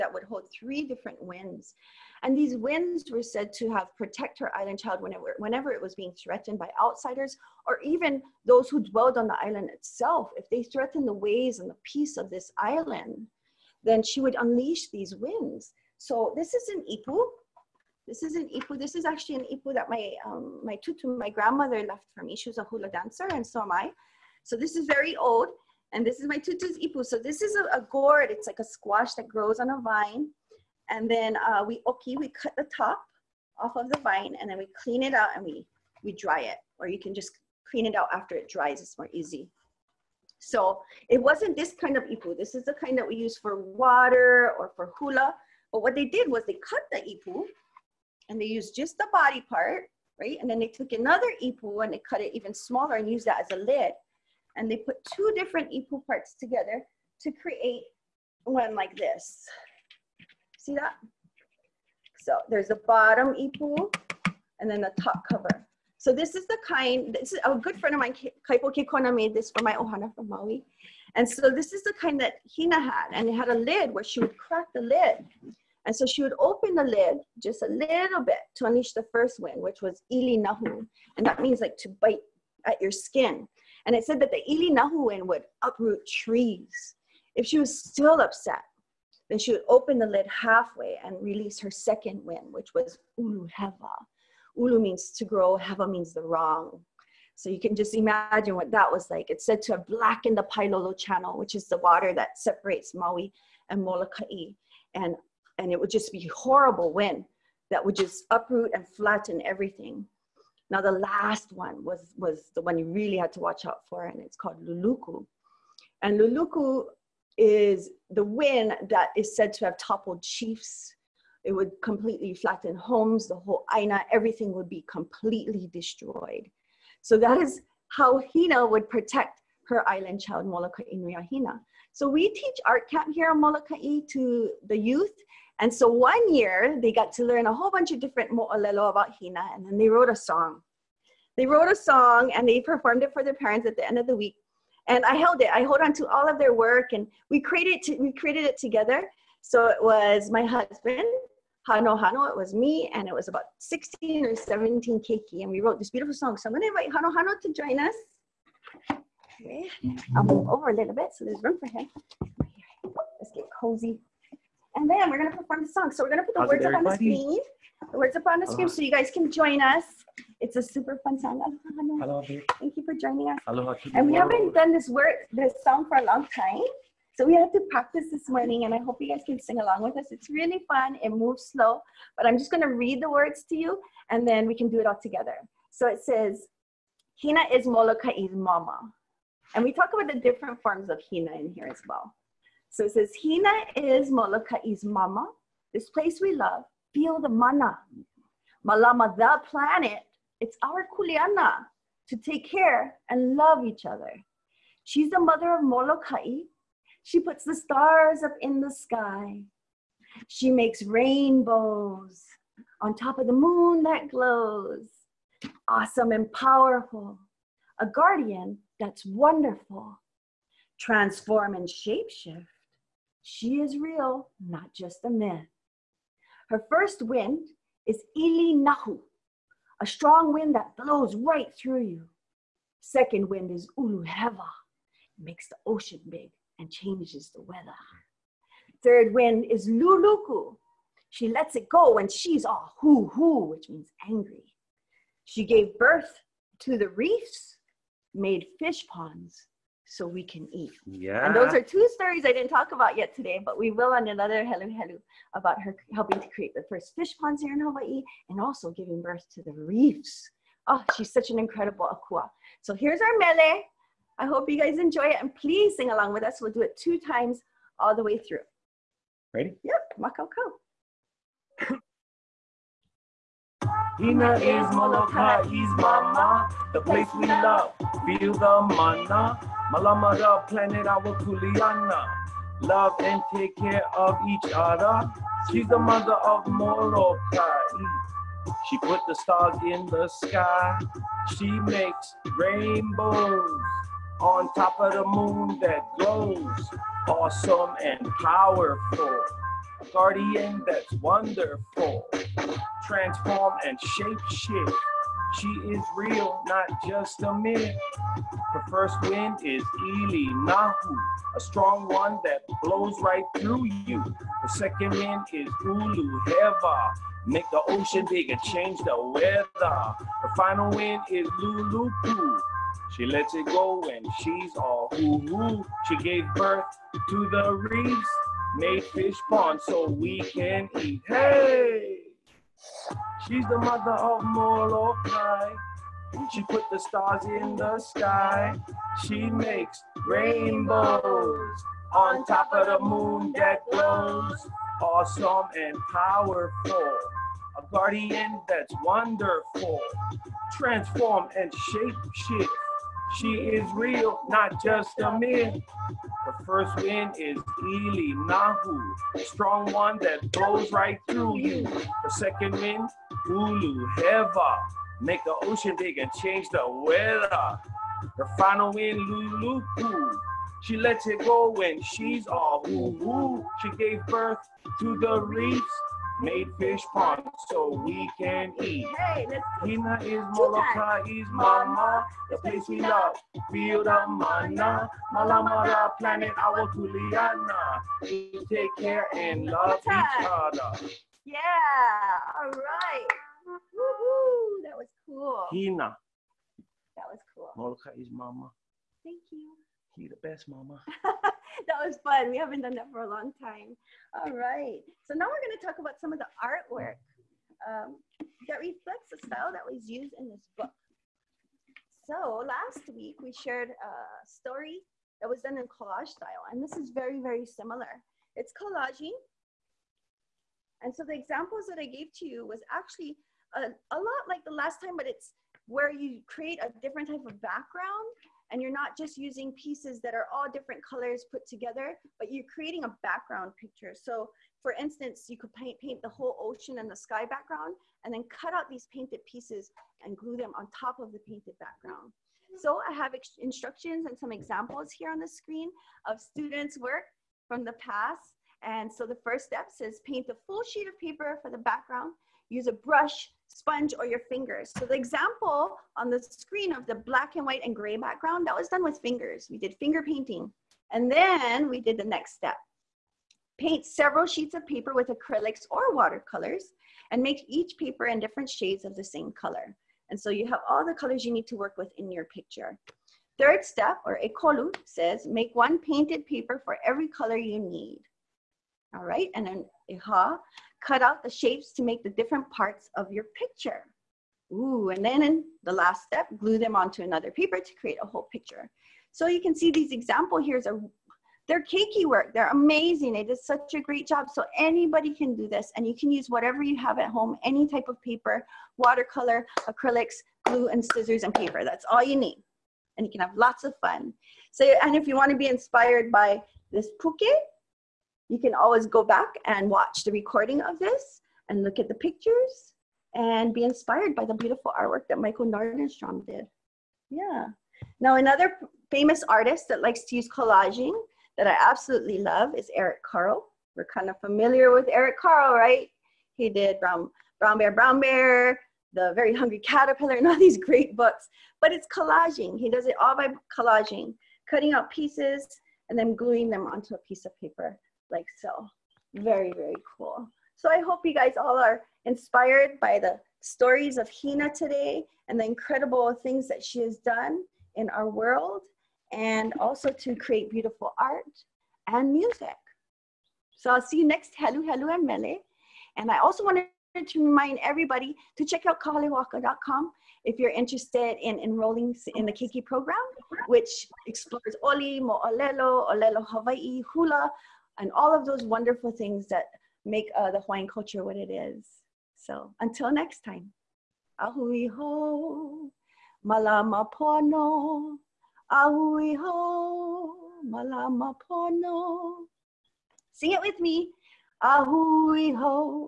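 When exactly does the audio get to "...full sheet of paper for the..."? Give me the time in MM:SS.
07:30.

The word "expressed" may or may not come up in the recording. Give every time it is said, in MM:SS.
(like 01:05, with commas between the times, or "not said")
not said.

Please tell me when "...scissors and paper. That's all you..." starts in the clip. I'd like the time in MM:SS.
08:20.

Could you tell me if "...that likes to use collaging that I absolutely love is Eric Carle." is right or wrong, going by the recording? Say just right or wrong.
right.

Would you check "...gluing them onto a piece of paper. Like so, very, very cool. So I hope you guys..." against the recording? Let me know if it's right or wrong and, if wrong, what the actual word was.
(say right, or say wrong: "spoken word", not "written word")
right.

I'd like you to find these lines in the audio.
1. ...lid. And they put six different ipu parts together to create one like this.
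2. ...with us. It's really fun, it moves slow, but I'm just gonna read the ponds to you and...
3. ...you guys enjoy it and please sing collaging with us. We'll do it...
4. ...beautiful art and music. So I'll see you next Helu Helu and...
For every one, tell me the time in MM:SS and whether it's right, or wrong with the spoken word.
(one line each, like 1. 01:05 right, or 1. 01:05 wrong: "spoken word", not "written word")
1. 00:53 wrong: "two", not "six"
2. 02:59 wrong: "words", not "ponds"
3. 04:24 wrong: "along", not "collaging"
4. 09:10 right.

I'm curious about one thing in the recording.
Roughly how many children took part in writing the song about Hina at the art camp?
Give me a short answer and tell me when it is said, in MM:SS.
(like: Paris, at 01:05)
16 or 17, at 02:33.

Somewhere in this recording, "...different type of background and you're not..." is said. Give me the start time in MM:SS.
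07:06.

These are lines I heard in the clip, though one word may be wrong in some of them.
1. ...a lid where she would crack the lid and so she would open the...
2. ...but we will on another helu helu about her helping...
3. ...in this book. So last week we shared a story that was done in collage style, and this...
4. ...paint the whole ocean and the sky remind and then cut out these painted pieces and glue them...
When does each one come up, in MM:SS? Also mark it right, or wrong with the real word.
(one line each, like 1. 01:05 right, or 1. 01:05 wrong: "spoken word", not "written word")
1. 01:13 right
2. 04:13 right
3. 06:50 right
4. 07:15 wrong: "background", not "remind".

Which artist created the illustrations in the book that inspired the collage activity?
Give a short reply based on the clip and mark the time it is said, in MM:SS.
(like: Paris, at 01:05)
Michael Nordenstrom, at 08:35.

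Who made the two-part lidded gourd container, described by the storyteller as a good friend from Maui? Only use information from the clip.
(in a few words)
Kaipo Kikona.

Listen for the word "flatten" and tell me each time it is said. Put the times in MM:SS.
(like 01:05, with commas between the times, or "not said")
01:48, 02:02.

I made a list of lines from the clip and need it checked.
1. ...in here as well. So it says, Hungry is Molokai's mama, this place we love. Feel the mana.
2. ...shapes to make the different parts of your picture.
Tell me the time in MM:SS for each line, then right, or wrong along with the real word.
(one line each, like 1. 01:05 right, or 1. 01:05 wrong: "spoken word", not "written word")
1. 03:11 wrong: "Hina", not "Hungry"
2. 08:01 right.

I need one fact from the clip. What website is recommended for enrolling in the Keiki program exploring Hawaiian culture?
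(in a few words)
kahalehoaka.com.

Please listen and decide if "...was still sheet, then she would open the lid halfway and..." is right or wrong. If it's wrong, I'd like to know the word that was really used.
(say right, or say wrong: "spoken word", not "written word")
wrong: "upset", not "sheet".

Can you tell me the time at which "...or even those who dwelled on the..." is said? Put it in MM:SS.
00:07.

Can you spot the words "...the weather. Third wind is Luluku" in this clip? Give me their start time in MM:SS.
03:57.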